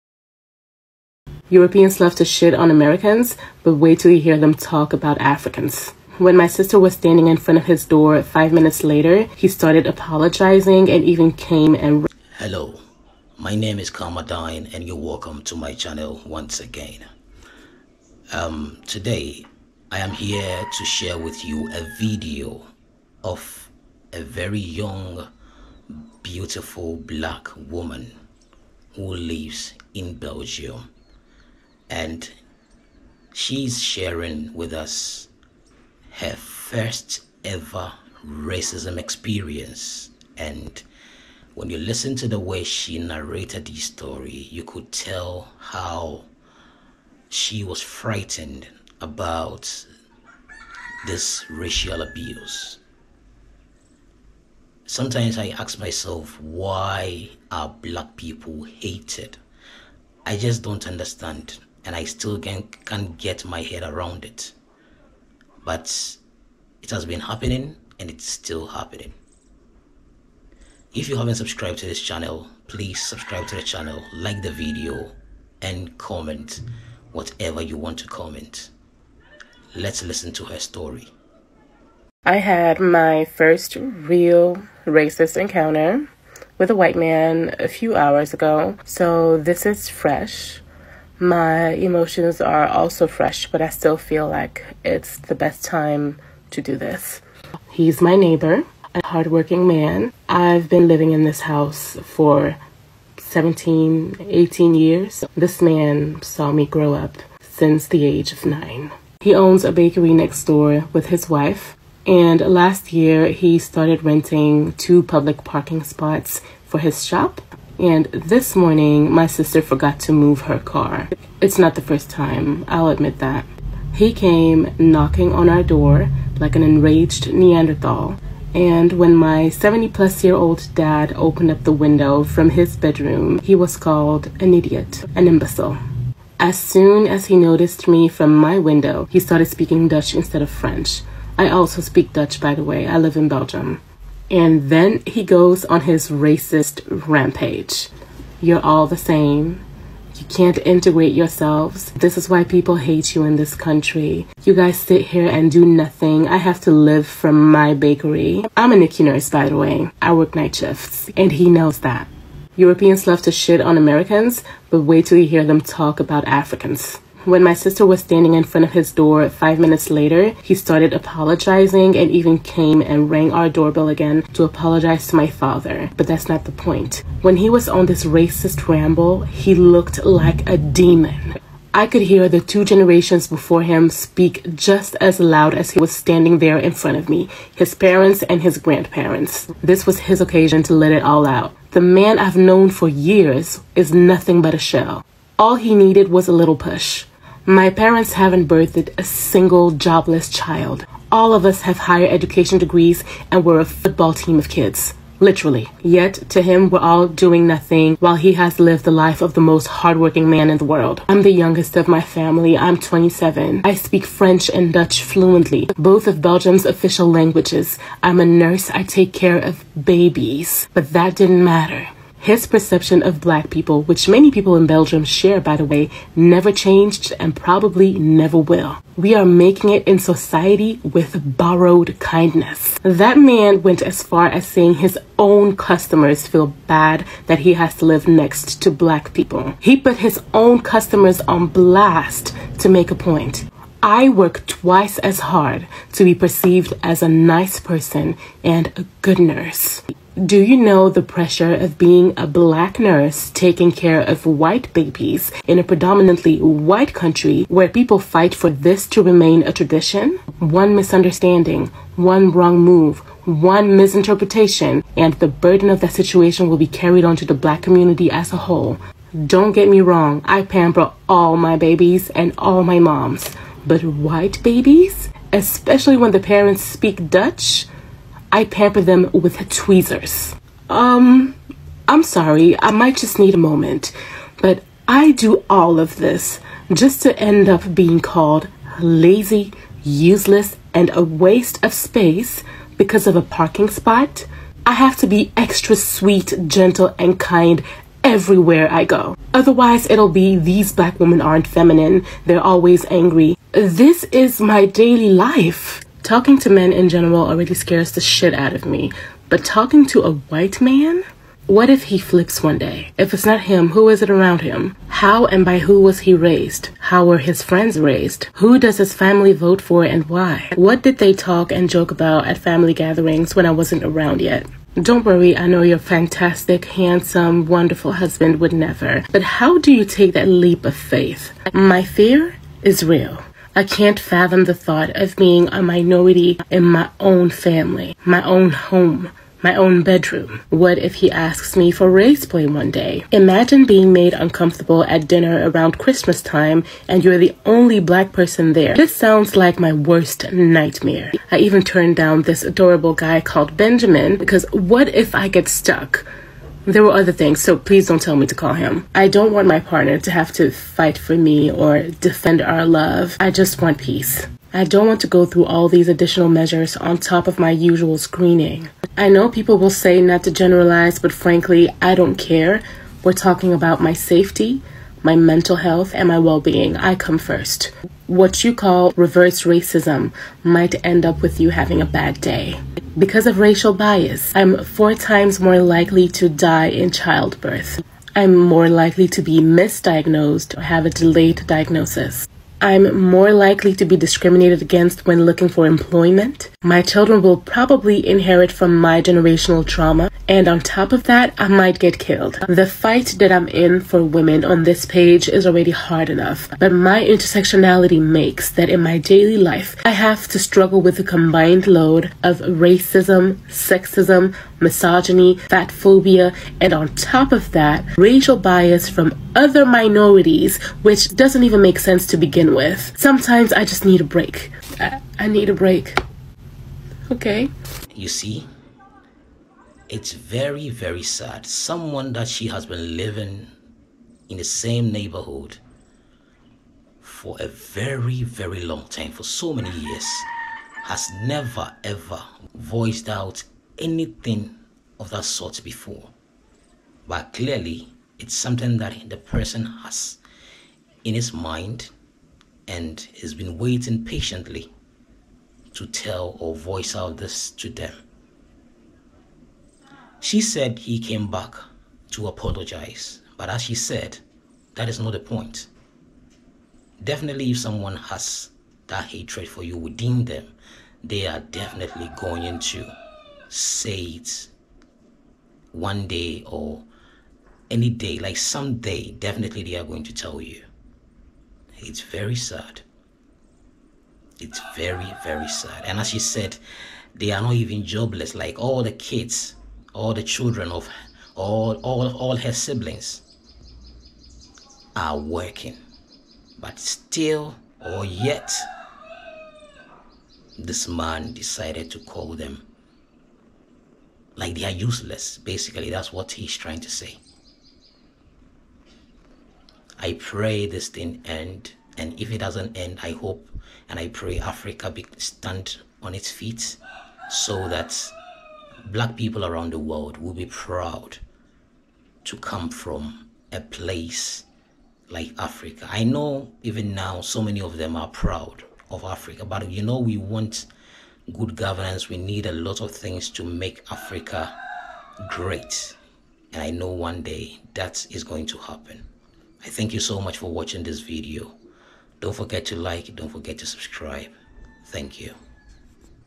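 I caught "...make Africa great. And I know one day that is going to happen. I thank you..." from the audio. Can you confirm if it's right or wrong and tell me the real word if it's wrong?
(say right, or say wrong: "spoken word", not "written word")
right.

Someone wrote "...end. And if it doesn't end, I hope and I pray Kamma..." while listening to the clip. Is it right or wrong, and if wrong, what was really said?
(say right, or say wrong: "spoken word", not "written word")
wrong: "Africa", not "Kamma".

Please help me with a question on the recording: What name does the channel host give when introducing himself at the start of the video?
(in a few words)
Kamma Dyn.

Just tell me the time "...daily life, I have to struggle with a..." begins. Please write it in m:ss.
6:48.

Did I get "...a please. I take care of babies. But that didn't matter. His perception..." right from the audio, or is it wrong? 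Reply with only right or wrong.
wrong.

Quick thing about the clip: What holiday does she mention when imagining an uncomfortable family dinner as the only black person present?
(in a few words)
Christmas.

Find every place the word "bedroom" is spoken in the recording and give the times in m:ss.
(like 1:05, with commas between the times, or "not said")
2:12, 5:39.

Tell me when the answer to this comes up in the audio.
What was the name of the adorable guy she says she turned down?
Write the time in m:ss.
5:53.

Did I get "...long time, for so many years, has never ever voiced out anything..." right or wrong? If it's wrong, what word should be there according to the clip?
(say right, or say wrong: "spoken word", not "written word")
right.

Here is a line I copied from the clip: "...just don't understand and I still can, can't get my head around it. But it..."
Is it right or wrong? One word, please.
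right.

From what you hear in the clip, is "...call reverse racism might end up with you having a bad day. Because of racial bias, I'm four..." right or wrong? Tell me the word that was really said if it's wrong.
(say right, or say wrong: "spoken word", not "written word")
right.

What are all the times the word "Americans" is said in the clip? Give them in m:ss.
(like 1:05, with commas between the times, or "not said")
0:02, 2:43.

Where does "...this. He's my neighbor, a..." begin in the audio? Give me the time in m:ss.
1:36.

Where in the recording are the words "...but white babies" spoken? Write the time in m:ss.
4:33.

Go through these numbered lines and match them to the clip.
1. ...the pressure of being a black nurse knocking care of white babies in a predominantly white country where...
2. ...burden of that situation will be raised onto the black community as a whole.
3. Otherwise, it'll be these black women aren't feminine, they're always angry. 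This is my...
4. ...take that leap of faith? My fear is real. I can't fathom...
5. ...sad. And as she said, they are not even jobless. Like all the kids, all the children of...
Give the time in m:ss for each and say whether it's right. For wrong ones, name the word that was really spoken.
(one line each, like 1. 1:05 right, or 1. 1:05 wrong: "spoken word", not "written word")
1. 4:10 wrong: "taking", not "knocking"
2. 4:25 wrong: "carried", not "raised"
3. 4:59 right
4. 5:29 right
5. 8:05 right.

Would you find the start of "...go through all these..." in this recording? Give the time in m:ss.
6:05.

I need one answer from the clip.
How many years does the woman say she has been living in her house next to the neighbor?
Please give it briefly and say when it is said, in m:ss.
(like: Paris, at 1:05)
17, 18 years, at 1:43.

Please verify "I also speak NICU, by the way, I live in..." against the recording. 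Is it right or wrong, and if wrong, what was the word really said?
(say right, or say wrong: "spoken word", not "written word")
wrong: "Dutch", not "NICU".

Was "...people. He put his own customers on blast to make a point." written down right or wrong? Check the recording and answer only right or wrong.
right.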